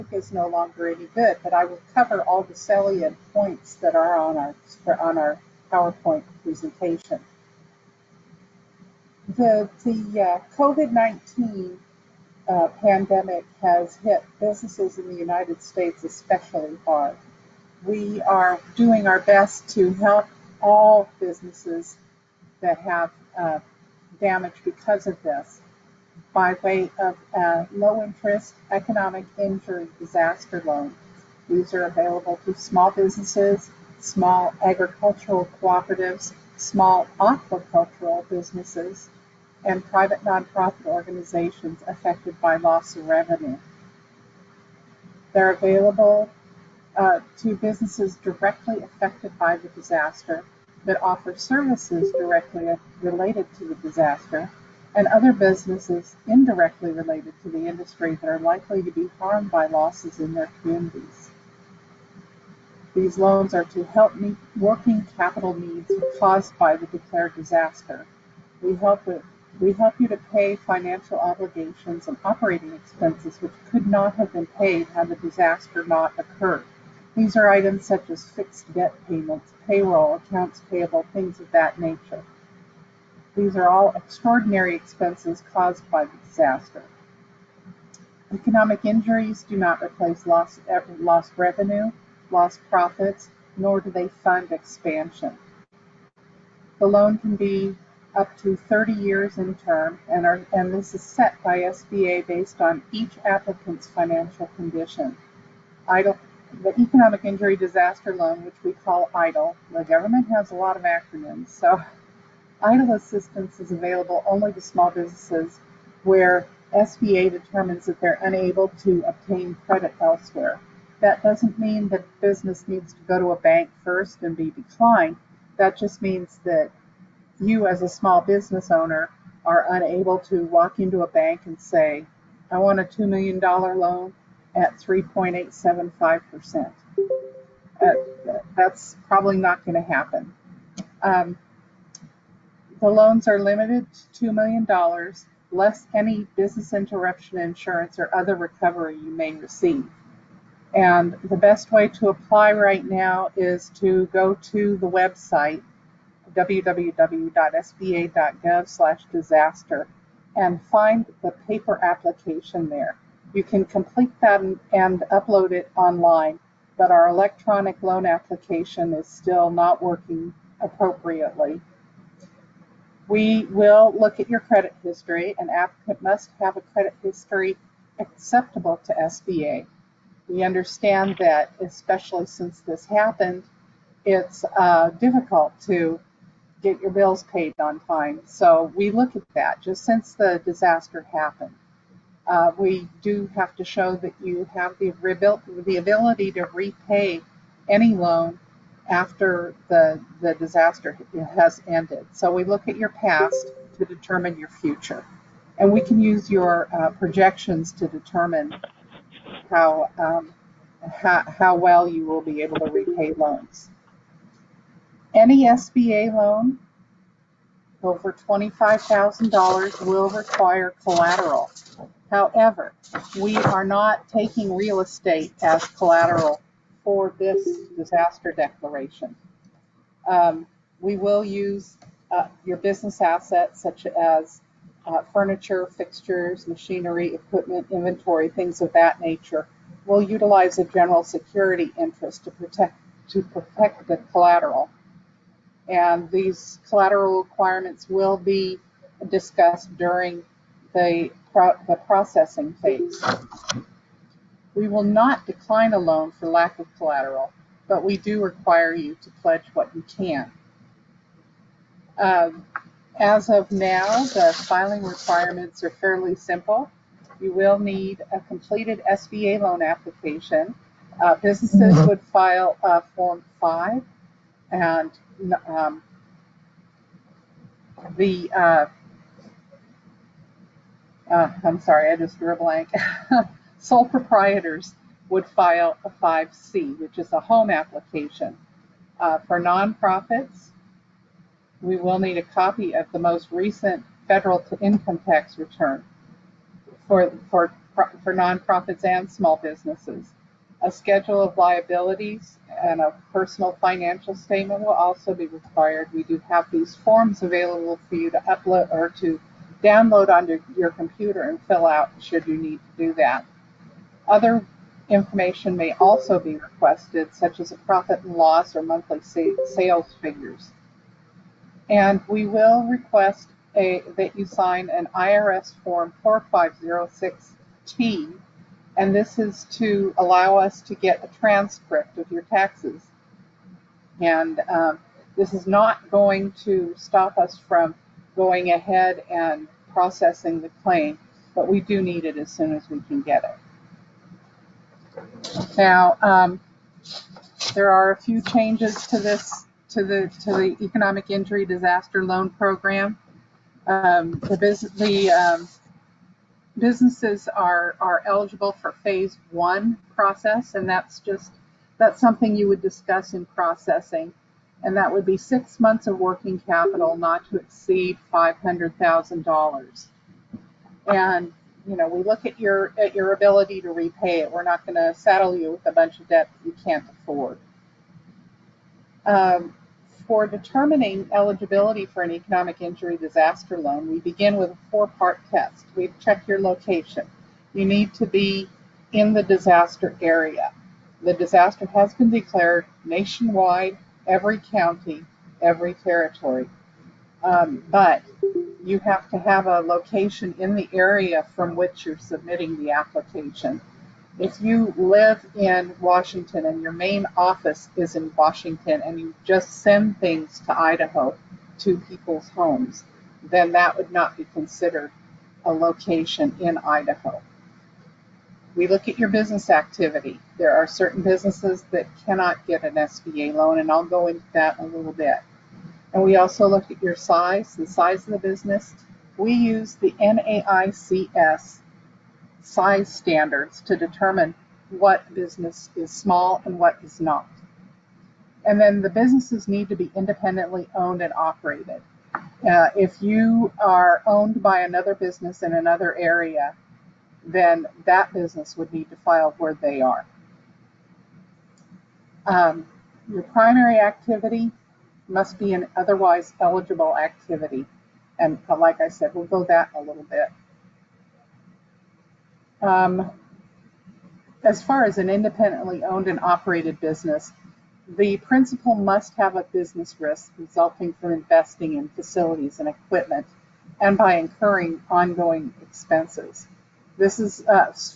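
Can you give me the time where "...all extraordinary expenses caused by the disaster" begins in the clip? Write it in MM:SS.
01:23.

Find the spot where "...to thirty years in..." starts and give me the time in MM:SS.
01:38.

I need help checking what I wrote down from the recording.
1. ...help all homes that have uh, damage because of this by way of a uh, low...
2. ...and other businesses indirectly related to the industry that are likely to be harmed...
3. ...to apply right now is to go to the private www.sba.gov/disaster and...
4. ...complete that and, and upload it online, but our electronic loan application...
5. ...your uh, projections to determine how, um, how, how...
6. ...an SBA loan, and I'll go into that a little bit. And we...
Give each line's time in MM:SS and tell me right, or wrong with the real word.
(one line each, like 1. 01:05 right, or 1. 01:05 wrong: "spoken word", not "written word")
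1. 00:19 wrong: "businesses", not "homes"
2. 00:54 right
3. 02:31 wrong: "website", not "private"
4. 02:43 right
5. 03:26 right
6. 07:02 right.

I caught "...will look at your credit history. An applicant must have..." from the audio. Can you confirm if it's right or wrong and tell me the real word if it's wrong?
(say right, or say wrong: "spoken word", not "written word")
right.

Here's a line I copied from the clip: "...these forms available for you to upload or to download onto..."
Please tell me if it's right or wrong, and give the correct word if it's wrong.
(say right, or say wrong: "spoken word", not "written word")
right.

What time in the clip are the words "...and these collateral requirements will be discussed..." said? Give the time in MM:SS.
04:05.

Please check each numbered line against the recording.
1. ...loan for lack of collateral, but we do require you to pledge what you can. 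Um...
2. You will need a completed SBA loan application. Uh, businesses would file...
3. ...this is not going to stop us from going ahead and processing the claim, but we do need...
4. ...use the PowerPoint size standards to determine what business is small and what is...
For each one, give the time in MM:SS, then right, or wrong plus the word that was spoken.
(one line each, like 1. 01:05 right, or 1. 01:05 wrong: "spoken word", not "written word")
1. 04:15 right
2. 04:27 right
3. 05:35 right
4. 07:09 wrong: "NAICS", not "PowerPoint".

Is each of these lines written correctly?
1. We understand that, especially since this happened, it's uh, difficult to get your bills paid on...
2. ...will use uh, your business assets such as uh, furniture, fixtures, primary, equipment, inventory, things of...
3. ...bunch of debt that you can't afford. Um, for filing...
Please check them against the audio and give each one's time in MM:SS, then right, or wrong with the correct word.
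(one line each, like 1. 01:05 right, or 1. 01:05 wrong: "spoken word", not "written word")
1. 03:00 right
2. 03:50 wrong: "machinery", not "primary"
3. 06:15 wrong: "determining", not "filing".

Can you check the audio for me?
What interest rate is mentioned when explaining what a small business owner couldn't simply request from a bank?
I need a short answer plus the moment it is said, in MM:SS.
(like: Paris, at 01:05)
3.875%, at 02:14.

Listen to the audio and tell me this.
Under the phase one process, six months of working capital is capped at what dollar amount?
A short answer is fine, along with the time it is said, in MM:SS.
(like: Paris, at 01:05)
$500,000, at 06:08.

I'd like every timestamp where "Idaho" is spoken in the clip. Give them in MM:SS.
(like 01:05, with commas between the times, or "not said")
06:50, 06:56.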